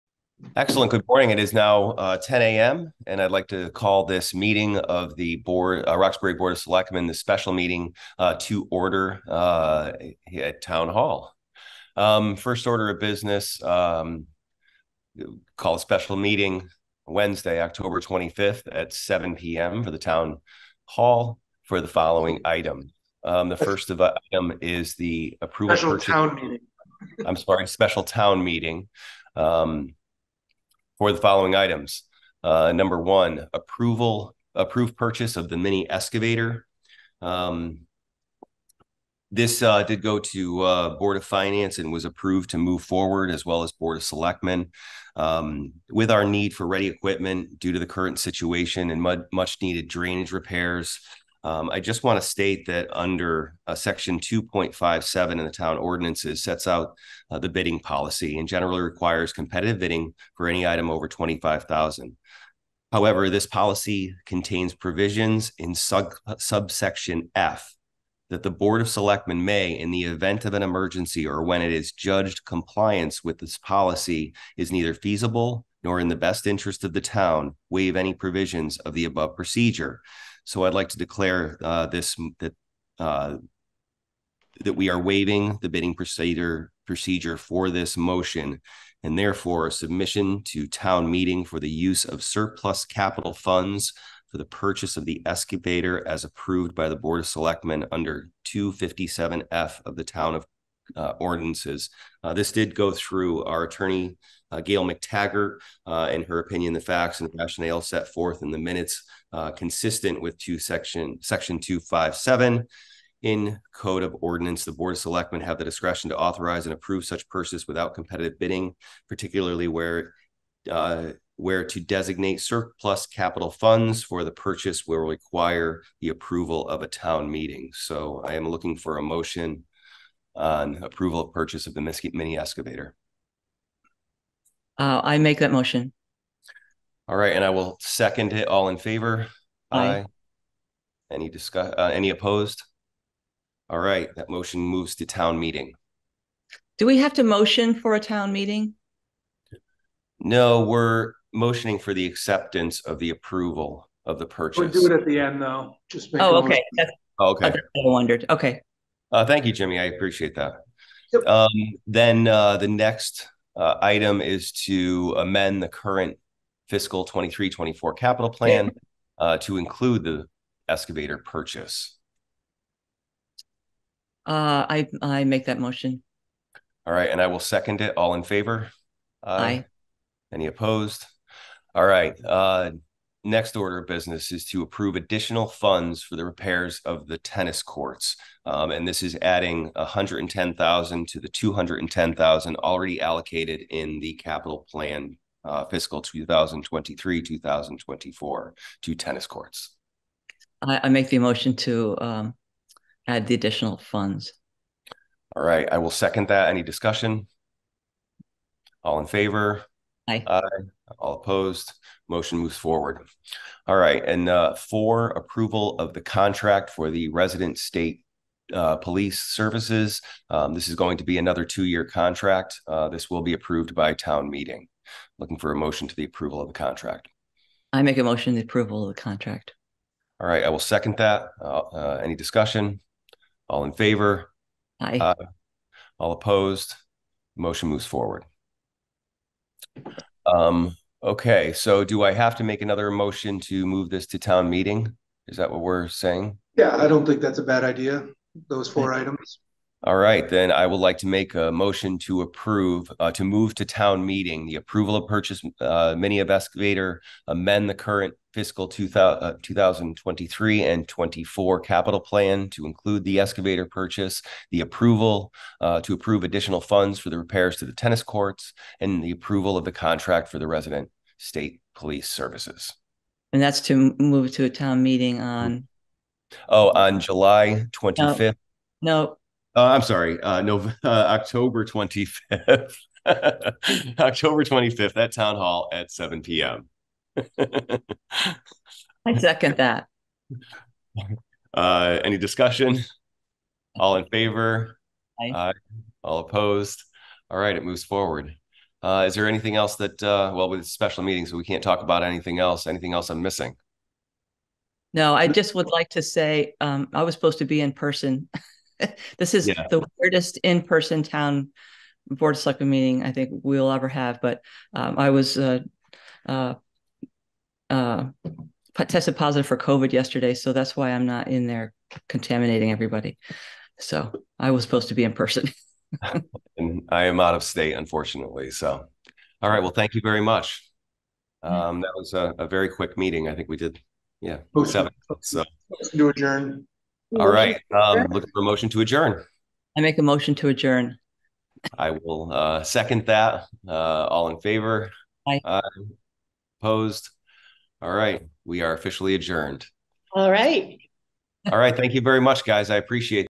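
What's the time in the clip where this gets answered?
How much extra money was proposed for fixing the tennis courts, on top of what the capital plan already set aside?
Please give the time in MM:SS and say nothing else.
03:09.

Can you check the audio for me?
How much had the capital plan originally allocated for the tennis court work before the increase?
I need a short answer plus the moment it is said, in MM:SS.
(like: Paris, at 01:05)
210000, at 03:11.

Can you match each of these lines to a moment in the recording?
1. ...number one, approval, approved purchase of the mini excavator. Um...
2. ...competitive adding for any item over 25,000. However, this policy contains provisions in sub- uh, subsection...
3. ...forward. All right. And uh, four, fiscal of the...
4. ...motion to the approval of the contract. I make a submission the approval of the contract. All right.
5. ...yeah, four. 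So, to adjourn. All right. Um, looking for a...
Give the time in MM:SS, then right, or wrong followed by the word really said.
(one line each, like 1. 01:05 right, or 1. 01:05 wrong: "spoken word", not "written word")
1. 00:32 right
2. 00:59 wrong: "bidding", not "adding"
3. 03:32 wrong: "approval", not "fiscal"
4. 03:45 wrong: "motion", not "submission"
5. 05:34 wrong: "seven", not "four".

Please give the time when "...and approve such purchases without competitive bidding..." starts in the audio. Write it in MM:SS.
01:56.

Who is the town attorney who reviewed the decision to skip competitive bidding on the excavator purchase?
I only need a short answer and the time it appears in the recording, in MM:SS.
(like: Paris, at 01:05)
Gail McTaggart, at 01:44.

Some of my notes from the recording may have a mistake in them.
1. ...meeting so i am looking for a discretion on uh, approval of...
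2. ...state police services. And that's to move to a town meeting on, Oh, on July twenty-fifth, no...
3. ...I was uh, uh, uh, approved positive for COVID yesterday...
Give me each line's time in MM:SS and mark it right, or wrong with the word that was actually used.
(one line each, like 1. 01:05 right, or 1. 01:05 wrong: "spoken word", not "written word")
1. 02:07 wrong: "motion", not "discretion"
2. 04:31 right
3. 05:14 wrong: "tested", not "approved".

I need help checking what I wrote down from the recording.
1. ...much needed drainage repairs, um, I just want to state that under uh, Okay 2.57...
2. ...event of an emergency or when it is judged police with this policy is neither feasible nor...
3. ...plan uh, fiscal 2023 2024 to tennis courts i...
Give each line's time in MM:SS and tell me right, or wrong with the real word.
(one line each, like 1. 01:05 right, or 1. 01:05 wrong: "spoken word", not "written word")
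1. 00:49 wrong: "Section", not "Okay"
2. 01:10 wrong: "compliance", not "police"
3. 03:14 right.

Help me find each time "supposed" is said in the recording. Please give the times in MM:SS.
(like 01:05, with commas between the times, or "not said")
05:07, 05:24.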